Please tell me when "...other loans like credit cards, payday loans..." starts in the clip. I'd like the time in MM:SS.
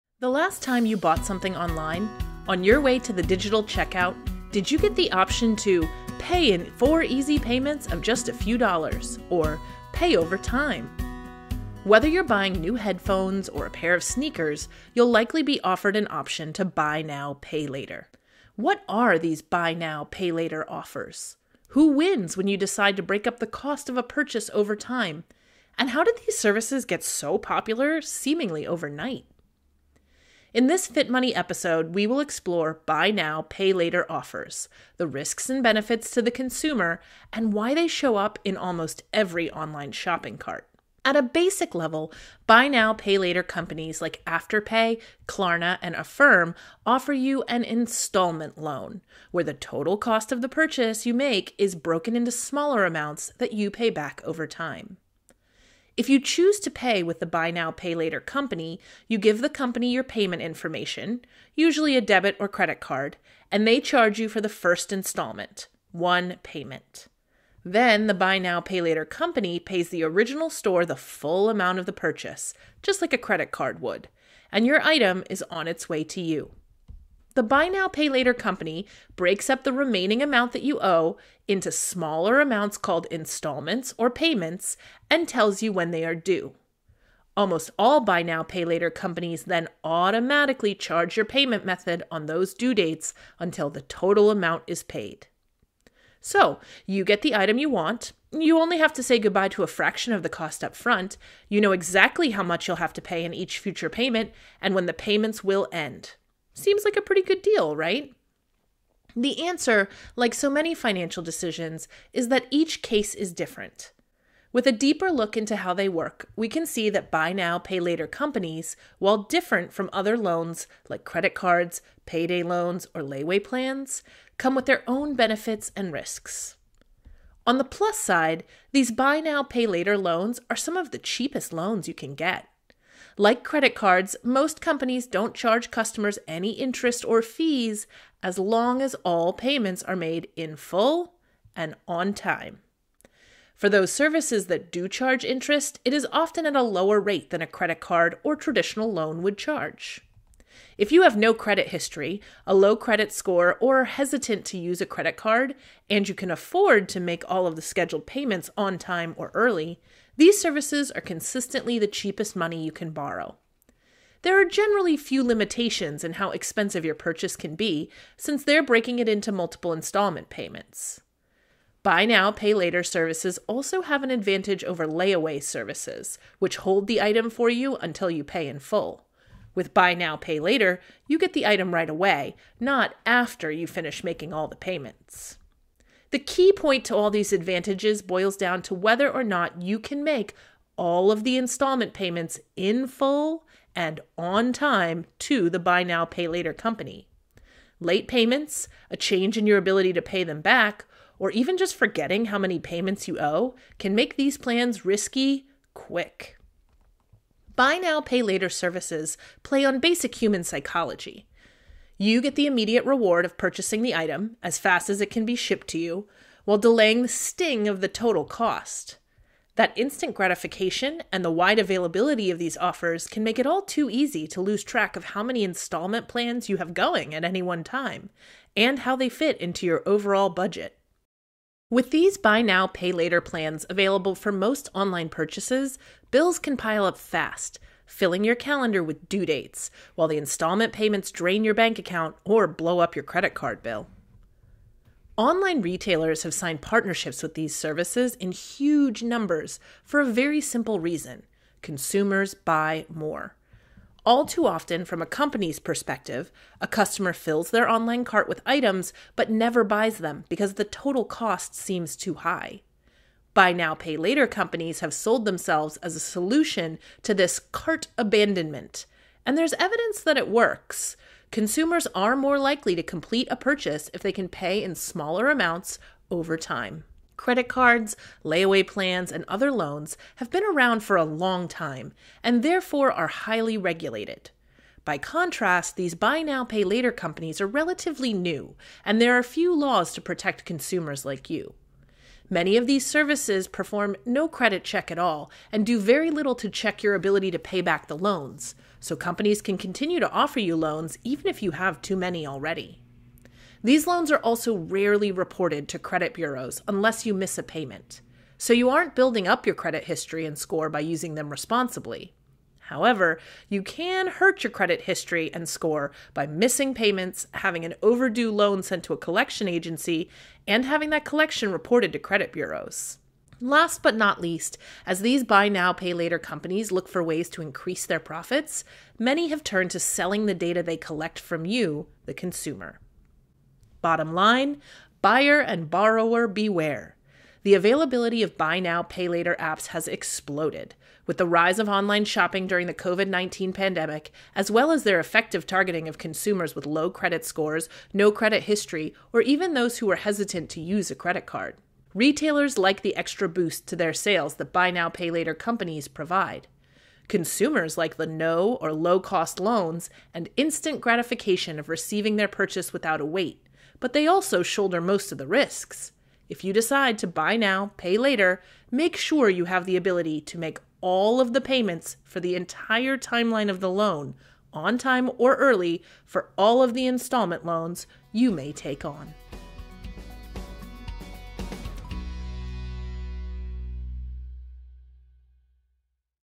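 01:59.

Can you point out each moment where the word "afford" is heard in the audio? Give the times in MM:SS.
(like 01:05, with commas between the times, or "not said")
02:36.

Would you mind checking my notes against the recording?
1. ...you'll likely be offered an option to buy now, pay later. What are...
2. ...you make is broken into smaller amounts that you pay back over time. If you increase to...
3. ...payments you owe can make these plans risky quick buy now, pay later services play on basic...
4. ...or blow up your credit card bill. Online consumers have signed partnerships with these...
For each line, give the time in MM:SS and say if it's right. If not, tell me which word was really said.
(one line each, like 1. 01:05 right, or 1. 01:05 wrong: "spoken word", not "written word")
1. 00:14 right
2. 00:51 wrong: "choose", not "increase"
3. 03:22 right
4. 04:02 wrong: "retailers", not "consumers".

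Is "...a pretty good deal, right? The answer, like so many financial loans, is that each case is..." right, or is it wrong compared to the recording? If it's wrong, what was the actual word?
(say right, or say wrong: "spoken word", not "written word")
wrong: "decisions", not "loans".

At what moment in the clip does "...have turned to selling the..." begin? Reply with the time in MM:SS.
05:29.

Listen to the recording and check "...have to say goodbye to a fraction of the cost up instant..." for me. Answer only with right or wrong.
wrong.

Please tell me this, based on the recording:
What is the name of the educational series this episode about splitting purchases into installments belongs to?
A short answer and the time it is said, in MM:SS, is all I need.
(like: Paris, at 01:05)
Fit Money, at 00:30.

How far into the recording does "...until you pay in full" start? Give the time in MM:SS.
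02:57.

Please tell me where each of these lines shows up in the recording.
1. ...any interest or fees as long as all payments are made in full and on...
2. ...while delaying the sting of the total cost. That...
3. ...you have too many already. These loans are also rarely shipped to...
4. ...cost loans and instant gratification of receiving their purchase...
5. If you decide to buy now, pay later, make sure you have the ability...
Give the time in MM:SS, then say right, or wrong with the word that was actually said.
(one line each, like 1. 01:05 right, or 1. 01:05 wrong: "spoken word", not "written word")
1. 02:16 right
2. 03:36 right
3. 05:01 wrong: "reported", not "shipped"
4. 05:58 right
5. 06:06 right.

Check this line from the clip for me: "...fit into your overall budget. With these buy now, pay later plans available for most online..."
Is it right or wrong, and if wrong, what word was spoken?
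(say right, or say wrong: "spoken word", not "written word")
right.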